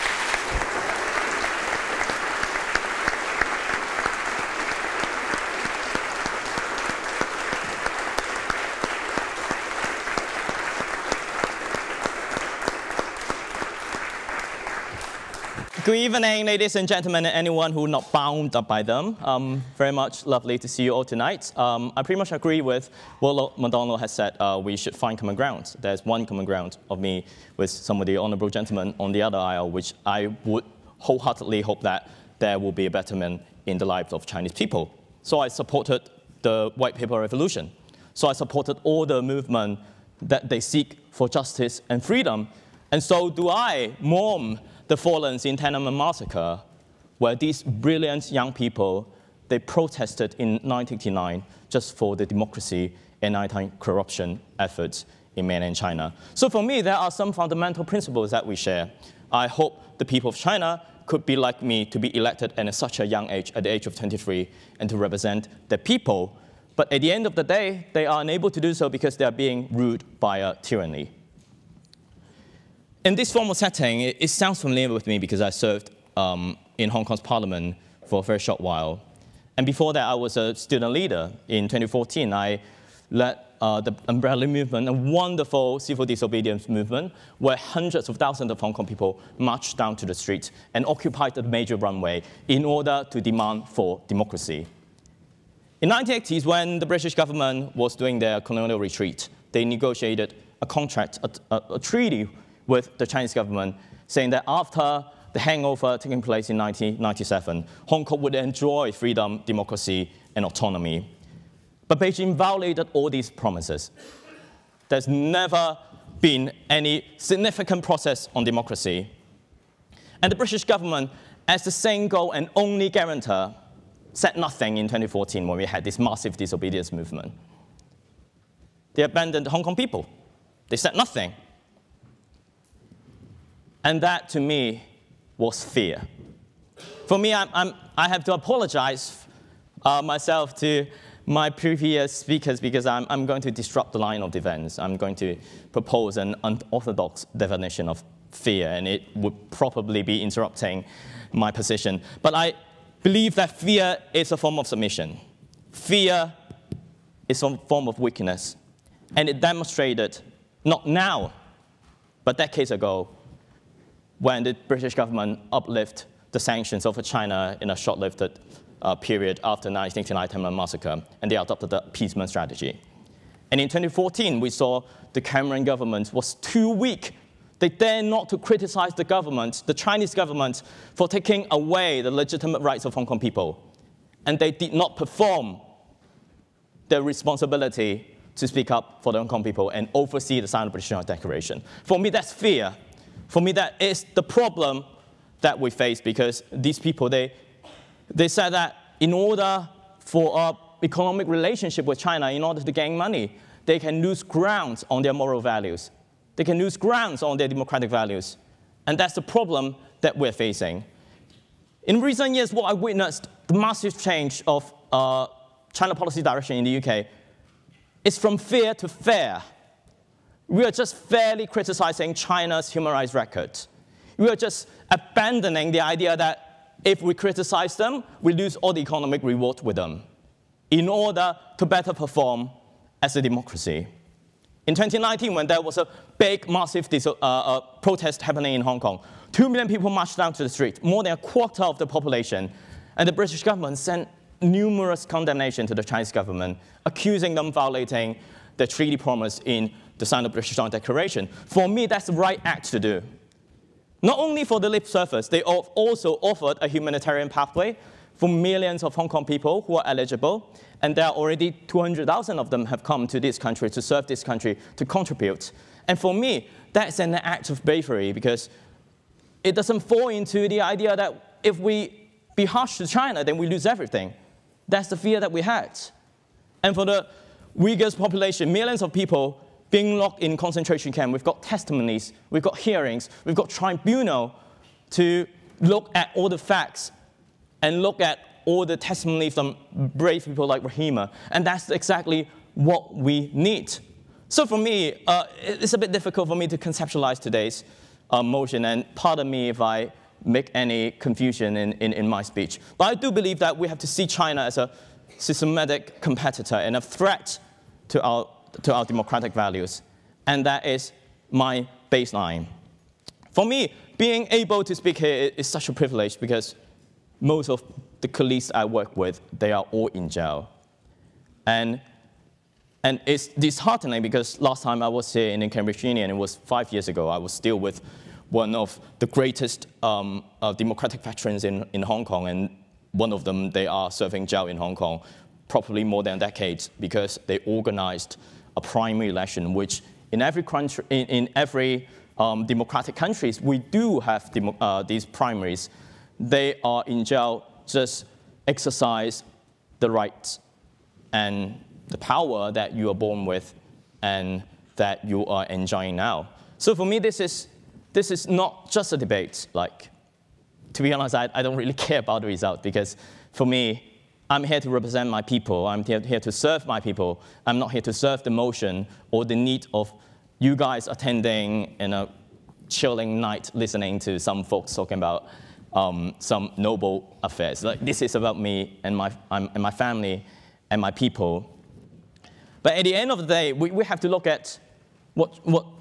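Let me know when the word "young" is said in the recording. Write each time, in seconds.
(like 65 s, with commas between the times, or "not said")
48 s, 63 s.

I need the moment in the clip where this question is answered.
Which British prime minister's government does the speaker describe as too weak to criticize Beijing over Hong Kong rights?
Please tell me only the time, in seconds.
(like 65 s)
175 s.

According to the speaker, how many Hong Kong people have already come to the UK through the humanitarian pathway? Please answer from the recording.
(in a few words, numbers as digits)
200,000.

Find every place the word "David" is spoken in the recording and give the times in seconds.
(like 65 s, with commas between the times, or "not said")
not said.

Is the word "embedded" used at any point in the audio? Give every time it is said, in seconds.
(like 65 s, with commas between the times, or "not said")
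not said.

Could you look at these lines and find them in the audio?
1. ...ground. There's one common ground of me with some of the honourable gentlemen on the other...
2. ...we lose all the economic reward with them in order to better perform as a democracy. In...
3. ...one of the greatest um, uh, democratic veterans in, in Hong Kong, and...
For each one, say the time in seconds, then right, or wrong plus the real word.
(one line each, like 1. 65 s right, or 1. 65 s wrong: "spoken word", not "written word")
1. 25 s right
2. 228 s right
3. 328 s right.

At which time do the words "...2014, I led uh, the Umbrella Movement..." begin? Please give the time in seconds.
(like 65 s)
81 s.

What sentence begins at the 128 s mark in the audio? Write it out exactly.
They abandoned the Hong Kong people.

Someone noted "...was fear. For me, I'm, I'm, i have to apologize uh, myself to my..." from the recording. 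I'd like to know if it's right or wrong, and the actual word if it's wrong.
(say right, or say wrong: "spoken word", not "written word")
right.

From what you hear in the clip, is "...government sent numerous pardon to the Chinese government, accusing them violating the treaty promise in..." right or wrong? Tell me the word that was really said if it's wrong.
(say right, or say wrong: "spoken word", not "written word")
wrong: "condemnation", not "pardon".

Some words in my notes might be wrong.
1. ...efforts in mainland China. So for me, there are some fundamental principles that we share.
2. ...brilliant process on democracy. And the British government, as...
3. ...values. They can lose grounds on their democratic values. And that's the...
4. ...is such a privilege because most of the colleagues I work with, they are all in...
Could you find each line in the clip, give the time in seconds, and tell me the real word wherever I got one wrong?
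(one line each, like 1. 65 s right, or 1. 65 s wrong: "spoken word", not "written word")
1. 54 s right
2. 117 s wrong: "significant", not "brilliant"
3. 205 s right
4. 315 s right.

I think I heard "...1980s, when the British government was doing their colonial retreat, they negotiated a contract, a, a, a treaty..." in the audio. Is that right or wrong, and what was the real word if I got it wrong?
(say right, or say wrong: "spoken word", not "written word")
right.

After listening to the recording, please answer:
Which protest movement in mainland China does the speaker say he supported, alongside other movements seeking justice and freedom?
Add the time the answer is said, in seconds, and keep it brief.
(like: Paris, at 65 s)
White Paper Revolution, at 36 s.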